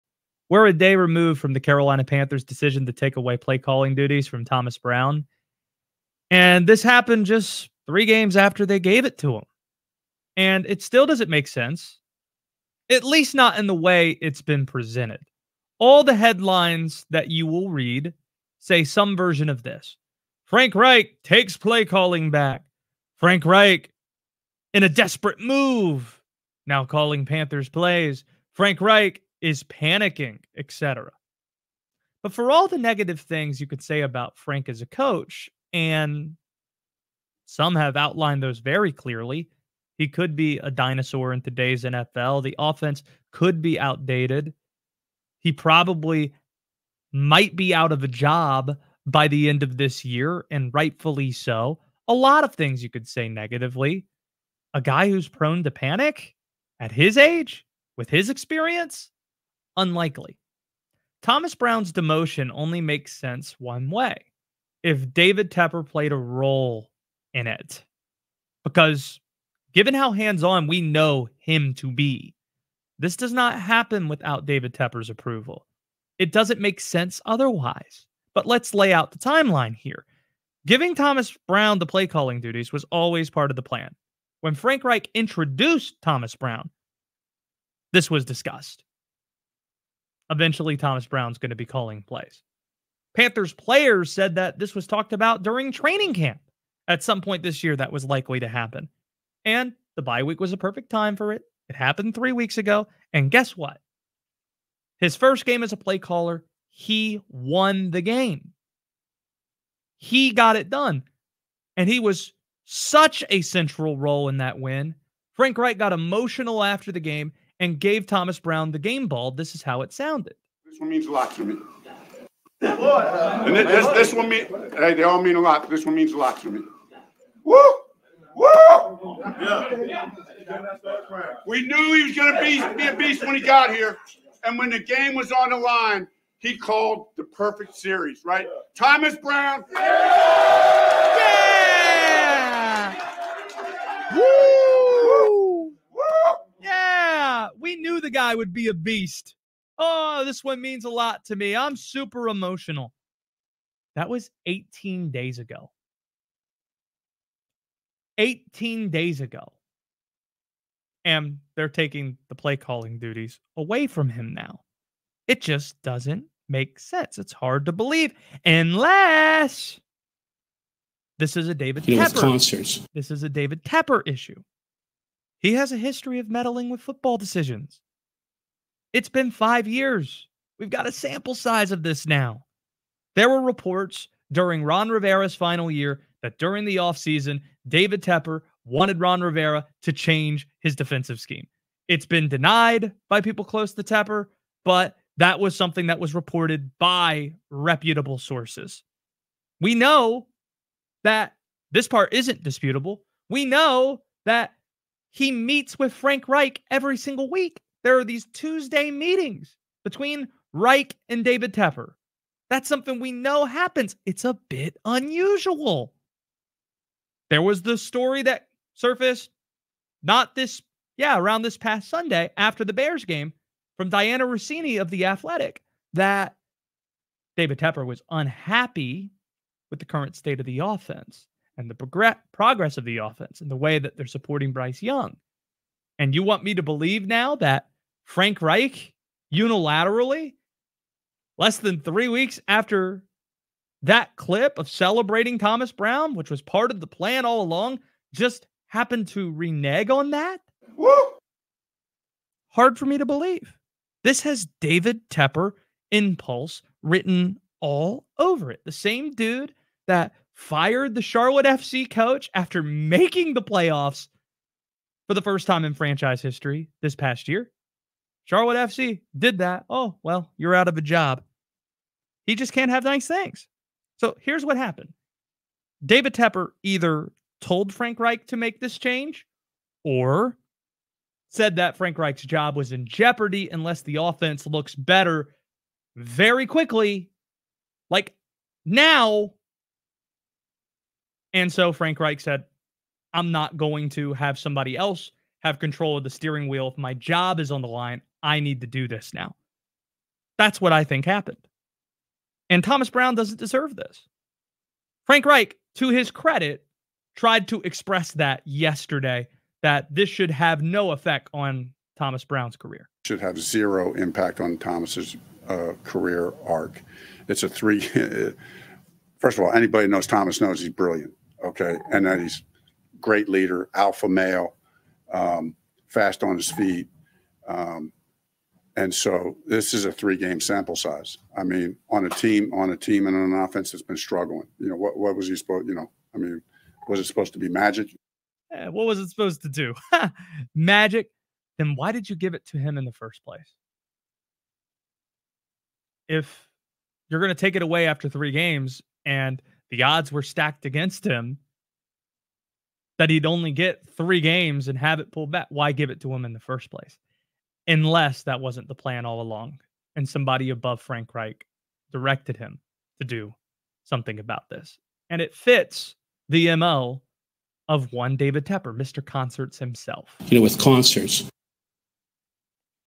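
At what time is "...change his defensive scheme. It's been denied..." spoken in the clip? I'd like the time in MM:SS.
03:09.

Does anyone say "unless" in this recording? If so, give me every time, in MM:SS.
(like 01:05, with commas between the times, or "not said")
02:48, 04:43, 05:57.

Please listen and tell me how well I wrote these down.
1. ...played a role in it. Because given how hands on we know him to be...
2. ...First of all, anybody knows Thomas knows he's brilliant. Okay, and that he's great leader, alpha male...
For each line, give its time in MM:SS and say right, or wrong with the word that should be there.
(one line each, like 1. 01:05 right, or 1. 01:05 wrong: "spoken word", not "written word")
1. 01:05 right
2. 05:19 right.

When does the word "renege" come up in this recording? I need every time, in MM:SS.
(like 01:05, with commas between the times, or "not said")
04:09.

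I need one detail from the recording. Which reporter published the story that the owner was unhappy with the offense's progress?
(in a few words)
Dianna Russini.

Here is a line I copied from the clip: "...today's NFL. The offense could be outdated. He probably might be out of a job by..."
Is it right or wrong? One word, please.
right.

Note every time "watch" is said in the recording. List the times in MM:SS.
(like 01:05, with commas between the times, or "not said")
not said.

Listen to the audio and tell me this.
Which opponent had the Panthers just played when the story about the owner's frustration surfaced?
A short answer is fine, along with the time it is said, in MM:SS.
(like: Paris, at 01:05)
Bears, at 03:42.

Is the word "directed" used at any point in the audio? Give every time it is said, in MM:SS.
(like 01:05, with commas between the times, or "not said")
06:01.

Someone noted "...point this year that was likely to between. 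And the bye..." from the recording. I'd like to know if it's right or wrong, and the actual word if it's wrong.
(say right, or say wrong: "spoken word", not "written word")
wrong: "happen", not "between".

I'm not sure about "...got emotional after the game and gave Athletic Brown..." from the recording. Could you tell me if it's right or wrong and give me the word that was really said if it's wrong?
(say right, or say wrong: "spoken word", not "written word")
wrong: "Thomas", not "Athletic".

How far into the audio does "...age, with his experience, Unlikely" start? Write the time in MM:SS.
00:57.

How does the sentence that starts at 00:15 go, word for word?
All the headlines that you will read say some version of this Frank Reich takes play calling back.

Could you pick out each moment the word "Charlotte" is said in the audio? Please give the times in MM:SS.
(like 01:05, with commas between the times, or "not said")
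04:21, 04:28.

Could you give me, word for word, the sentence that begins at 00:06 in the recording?
And this happened just three games after they gave it to him.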